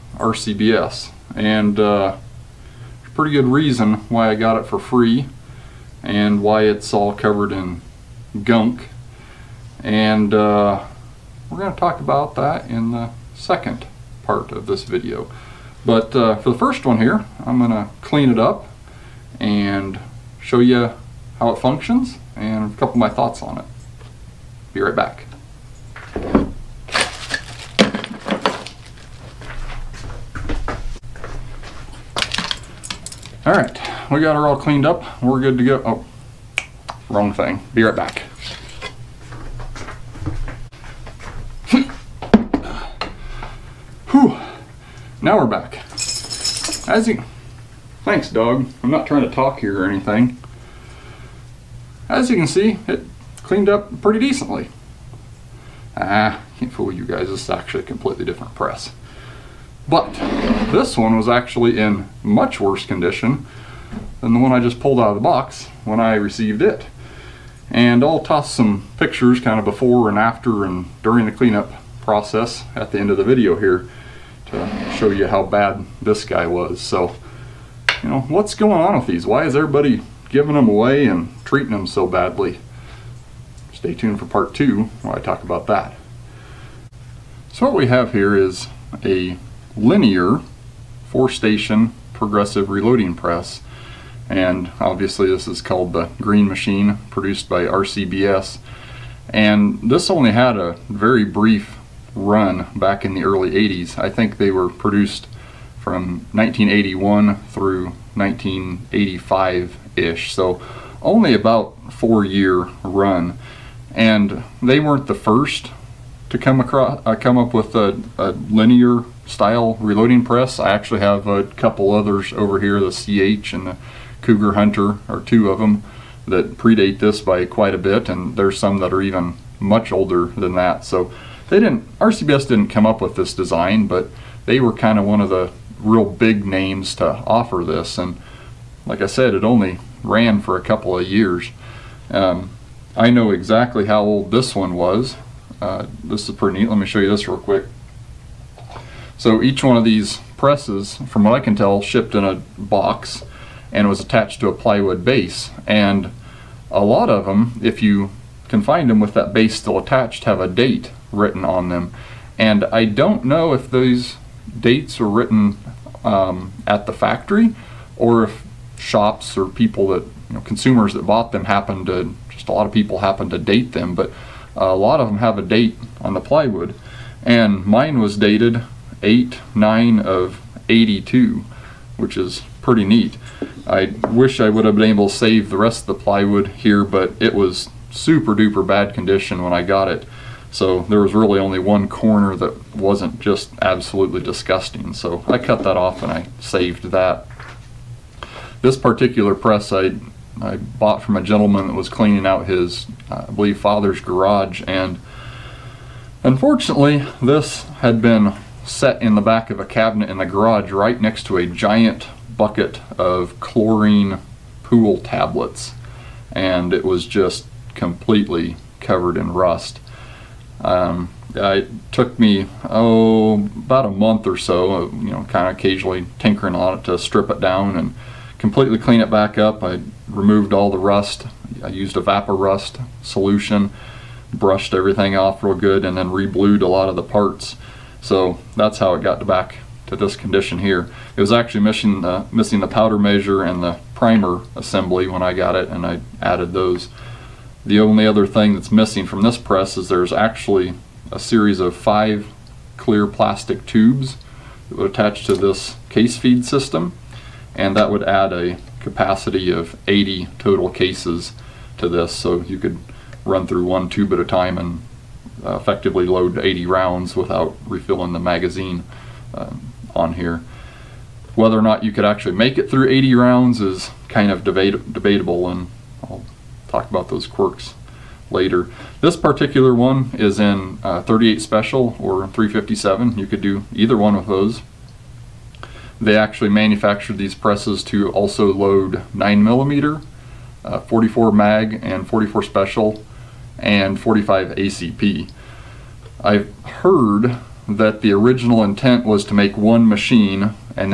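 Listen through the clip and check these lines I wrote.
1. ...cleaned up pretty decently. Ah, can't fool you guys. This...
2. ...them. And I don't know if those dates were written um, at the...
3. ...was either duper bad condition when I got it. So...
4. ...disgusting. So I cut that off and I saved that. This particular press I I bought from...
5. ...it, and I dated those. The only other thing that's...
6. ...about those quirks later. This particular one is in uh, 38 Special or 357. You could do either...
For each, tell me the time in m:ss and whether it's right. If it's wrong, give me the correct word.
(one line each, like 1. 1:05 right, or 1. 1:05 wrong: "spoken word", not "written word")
1. 0:53 right
2. 2:41 right
3. 3:07 wrong: "super", not "either"
4. 3:14 right
5. 4:05 wrong: "added", not "dated"
6. 4:36 right.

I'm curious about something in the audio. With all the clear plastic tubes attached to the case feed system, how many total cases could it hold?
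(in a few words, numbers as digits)
80.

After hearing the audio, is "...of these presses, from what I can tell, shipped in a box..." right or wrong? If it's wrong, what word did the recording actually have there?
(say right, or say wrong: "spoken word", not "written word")
right.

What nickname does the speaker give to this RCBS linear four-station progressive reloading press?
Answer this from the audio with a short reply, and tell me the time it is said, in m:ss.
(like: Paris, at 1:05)
green machine, at 1:36.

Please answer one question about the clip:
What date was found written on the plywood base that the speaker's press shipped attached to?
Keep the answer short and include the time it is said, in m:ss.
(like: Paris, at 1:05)
8/9/82, at 2:59.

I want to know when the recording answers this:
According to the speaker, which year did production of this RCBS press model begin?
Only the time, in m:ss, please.
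1:46.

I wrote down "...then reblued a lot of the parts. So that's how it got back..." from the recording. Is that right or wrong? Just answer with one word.
right.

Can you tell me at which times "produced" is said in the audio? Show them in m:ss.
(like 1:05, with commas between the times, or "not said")
1:37, 1:44.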